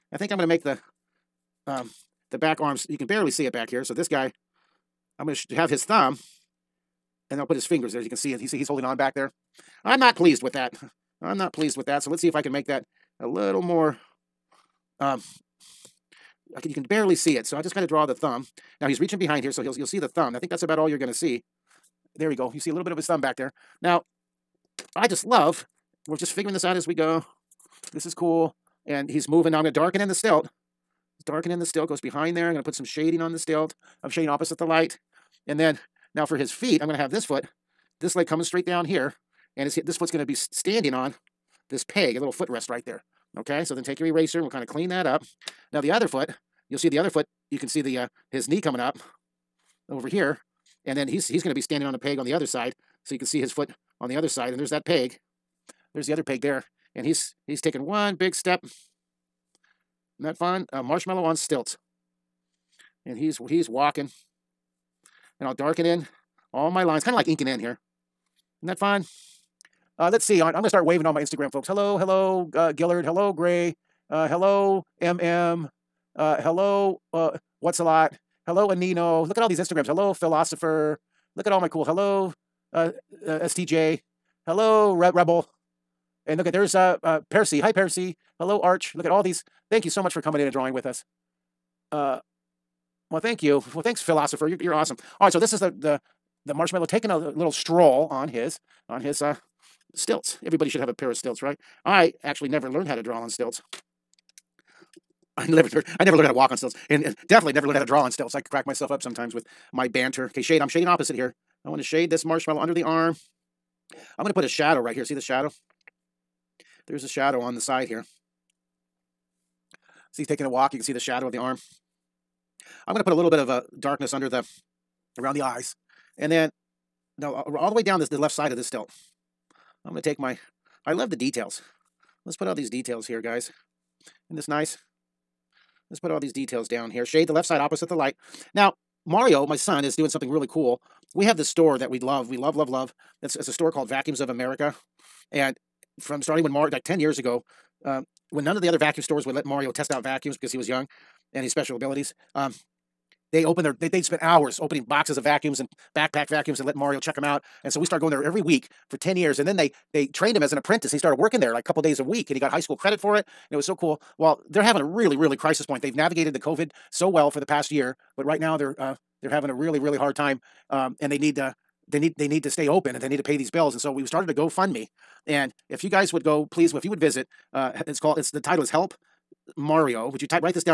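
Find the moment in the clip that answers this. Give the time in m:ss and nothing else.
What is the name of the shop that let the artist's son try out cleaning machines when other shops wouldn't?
2:23.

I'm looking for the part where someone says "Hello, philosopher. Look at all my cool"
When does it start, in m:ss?
1:19.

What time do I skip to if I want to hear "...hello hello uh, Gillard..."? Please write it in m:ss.
1:11.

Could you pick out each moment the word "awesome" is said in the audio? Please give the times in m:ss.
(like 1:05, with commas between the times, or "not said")
1:34.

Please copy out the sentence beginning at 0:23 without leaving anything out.
Now, I just love, we're just figuring this out as we go.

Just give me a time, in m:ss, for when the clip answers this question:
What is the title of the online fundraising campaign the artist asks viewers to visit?
2:58.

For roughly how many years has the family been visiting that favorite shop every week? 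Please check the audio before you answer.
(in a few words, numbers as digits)
10.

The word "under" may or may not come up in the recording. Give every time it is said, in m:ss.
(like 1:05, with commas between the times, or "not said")
1:52, 2:04.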